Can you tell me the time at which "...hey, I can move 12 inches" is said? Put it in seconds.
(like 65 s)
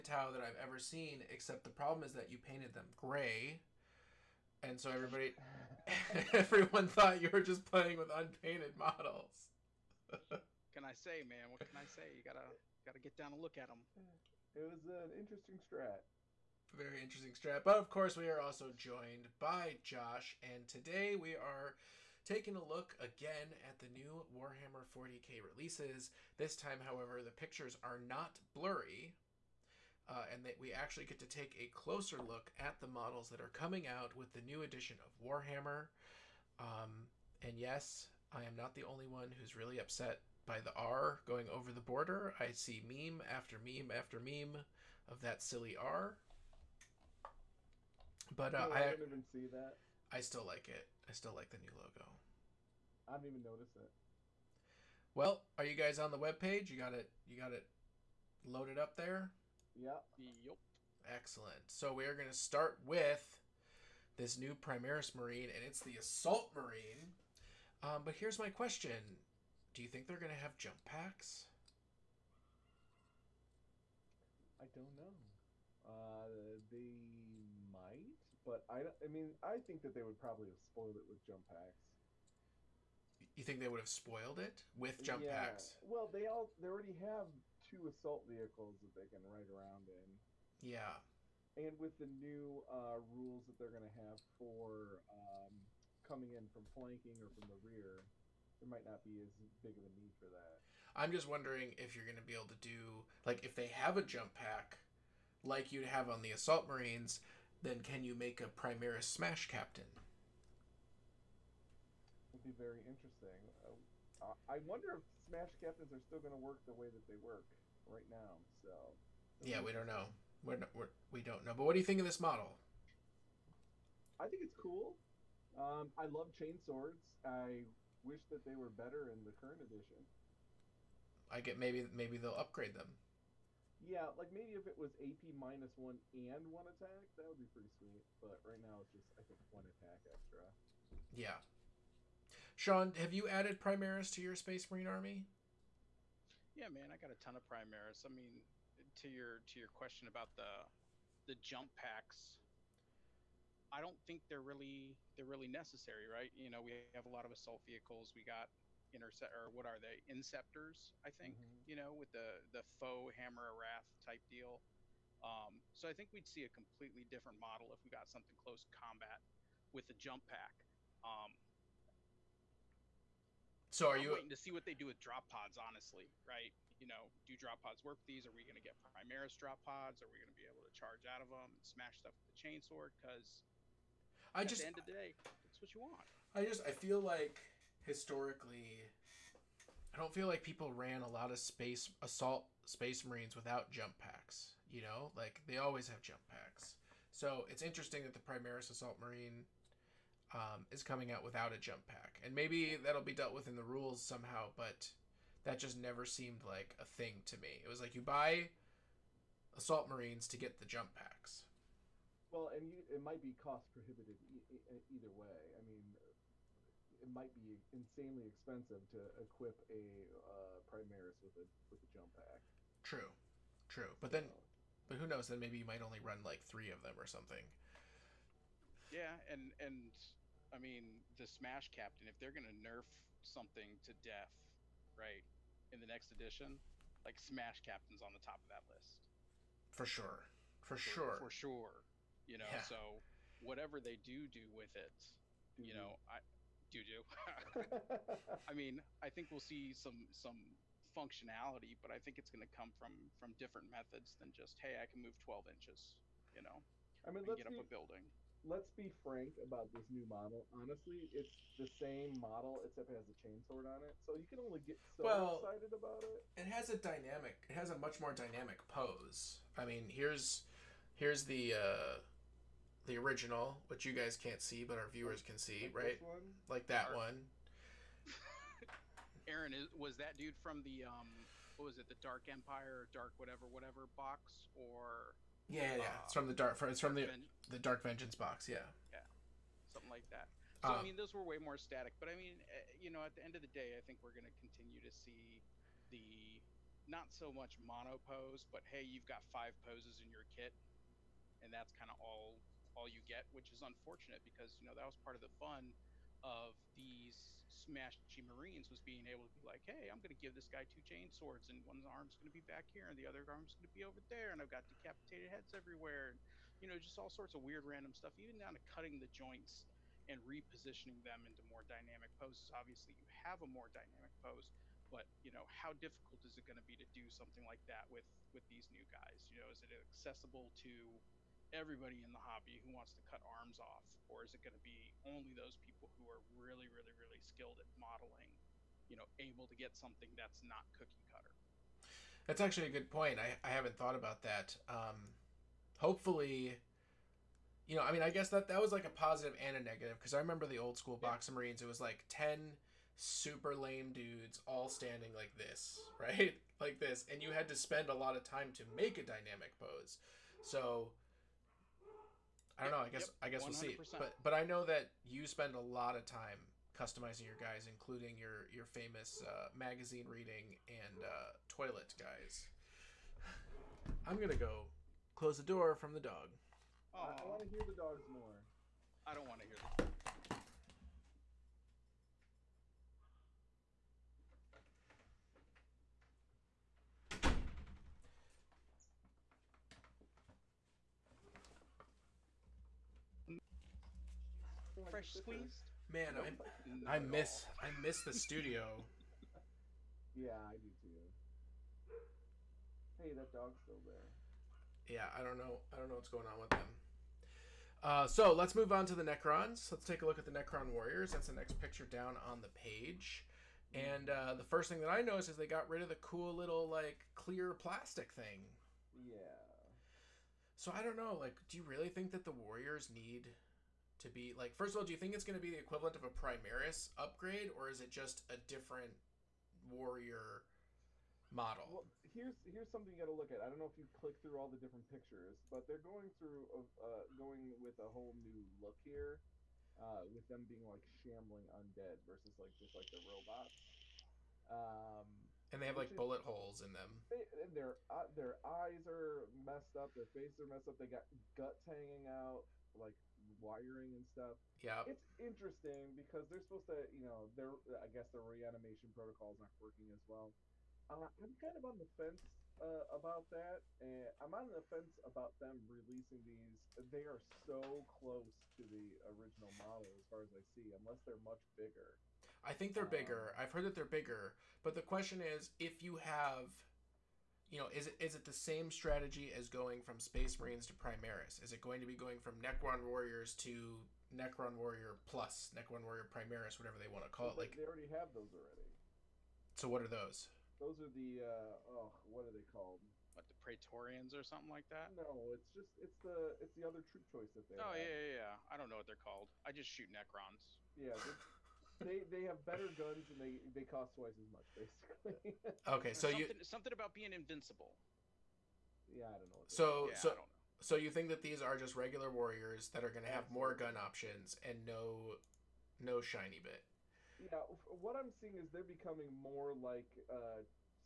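254 s.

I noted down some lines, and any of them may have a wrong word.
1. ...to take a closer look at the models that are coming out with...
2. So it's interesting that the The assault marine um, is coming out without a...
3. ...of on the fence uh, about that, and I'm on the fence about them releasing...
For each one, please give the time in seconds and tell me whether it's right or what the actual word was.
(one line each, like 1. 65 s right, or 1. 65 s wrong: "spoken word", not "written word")
1. 31 s right
2. 197 s wrong: "Primaris", not "The"
3. 461 s right.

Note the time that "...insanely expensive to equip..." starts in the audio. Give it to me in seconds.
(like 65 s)
217 s.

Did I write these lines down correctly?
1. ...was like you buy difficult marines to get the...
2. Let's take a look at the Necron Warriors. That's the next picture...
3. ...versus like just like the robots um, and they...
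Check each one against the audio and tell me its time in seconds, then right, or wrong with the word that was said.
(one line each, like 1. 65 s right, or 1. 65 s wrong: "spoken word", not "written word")
1. 207 s wrong: "assault", not "difficult"
2. 409 s right
3. 442 s right.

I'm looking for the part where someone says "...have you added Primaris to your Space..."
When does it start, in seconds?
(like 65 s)
142 s.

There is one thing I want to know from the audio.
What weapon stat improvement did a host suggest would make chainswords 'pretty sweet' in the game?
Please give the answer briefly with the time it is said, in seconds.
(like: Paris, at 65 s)
AP minus one, at 134 s.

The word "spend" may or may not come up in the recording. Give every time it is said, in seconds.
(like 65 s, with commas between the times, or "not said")
357 s, 365 s.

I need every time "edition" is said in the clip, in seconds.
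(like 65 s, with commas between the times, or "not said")
34 s, 129 s, 236 s.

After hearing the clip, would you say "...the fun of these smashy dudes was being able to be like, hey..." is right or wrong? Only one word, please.
wrong.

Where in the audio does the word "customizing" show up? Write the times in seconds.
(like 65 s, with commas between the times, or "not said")
366 s.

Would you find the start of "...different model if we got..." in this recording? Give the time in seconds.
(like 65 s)
167 s.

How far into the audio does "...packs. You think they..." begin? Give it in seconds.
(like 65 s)
81 s.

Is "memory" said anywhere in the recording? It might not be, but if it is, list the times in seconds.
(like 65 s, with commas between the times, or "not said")
not said.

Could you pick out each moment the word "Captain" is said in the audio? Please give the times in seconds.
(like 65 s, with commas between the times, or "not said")
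109 s, 115 s, 231 s, 237 s.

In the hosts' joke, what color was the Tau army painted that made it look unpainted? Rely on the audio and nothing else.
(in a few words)
gray.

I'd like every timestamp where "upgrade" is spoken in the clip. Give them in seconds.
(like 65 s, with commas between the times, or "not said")
132 s, 426 s.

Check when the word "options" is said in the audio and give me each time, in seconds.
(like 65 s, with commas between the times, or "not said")
513 s.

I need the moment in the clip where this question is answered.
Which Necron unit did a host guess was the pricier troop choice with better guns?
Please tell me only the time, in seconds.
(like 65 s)
493 s.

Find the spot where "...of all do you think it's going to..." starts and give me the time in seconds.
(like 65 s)
424 s.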